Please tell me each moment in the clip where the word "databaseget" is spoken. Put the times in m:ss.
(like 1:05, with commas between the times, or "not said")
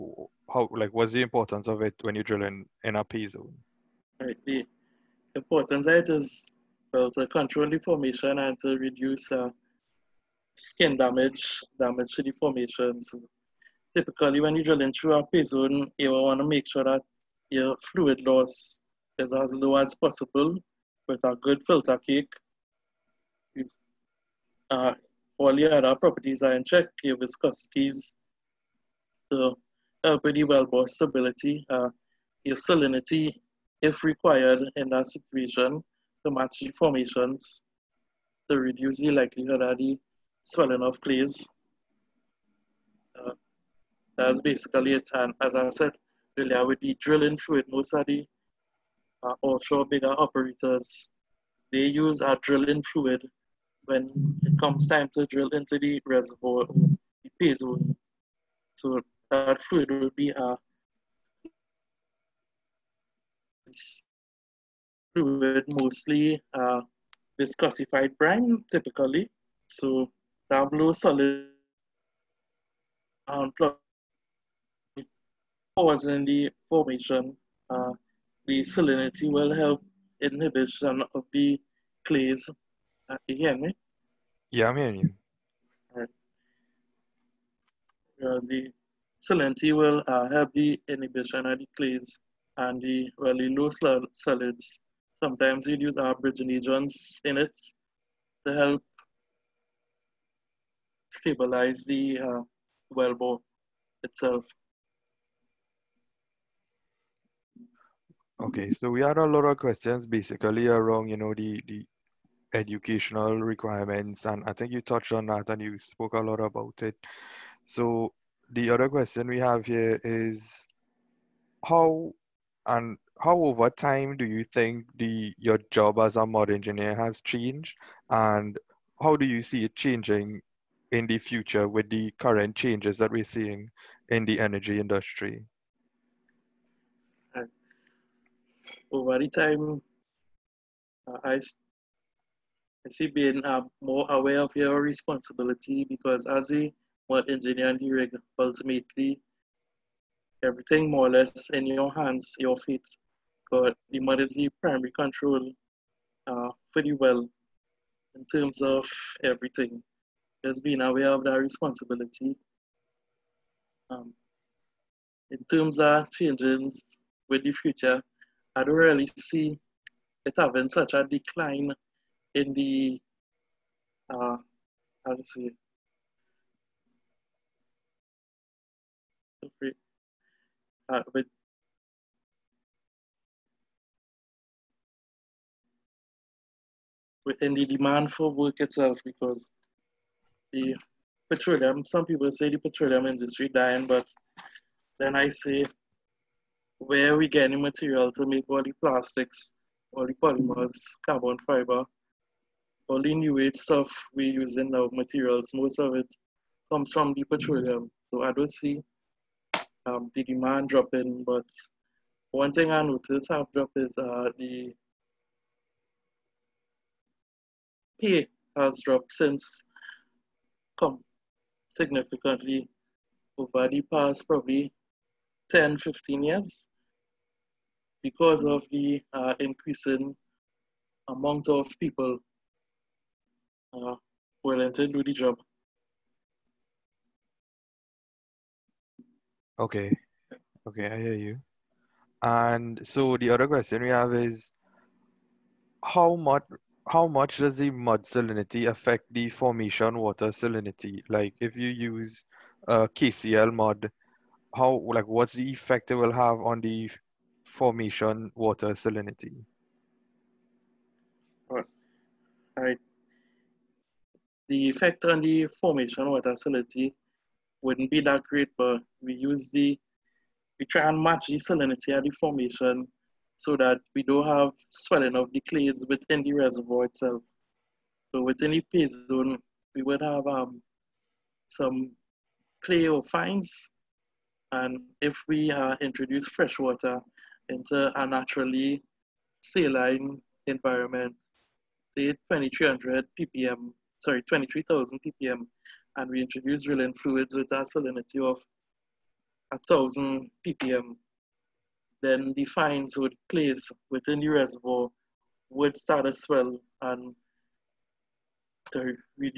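not said.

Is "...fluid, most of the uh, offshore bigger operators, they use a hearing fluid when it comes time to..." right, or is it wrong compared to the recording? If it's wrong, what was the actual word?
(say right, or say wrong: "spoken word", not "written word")
wrong: "drilling", not "hearing".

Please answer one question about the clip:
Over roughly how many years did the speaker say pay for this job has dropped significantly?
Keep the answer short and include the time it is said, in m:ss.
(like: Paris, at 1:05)
10 to 15 years, at 3:45.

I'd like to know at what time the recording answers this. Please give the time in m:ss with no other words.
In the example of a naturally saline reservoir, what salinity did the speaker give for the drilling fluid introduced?
4:59.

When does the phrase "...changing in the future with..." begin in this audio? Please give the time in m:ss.
2:09.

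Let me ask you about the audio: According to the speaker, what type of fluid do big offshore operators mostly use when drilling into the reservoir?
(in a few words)
viscosified brine.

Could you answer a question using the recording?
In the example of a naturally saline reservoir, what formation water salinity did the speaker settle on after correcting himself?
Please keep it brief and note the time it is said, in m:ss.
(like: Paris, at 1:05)
23,000 ppm, at 4:54.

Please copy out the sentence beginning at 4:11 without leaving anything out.
Like if you use uh, KCl mud, how like what's the effect it will have on the formation water salinity?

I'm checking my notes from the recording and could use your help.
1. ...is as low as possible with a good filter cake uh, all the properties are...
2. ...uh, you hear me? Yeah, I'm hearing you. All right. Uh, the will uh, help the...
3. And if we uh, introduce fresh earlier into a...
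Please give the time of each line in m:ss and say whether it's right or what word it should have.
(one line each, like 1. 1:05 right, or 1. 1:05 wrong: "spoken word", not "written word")
1. 0:19 right
2. 1:23 right
3. 4:44 wrong: "water", not "earlier".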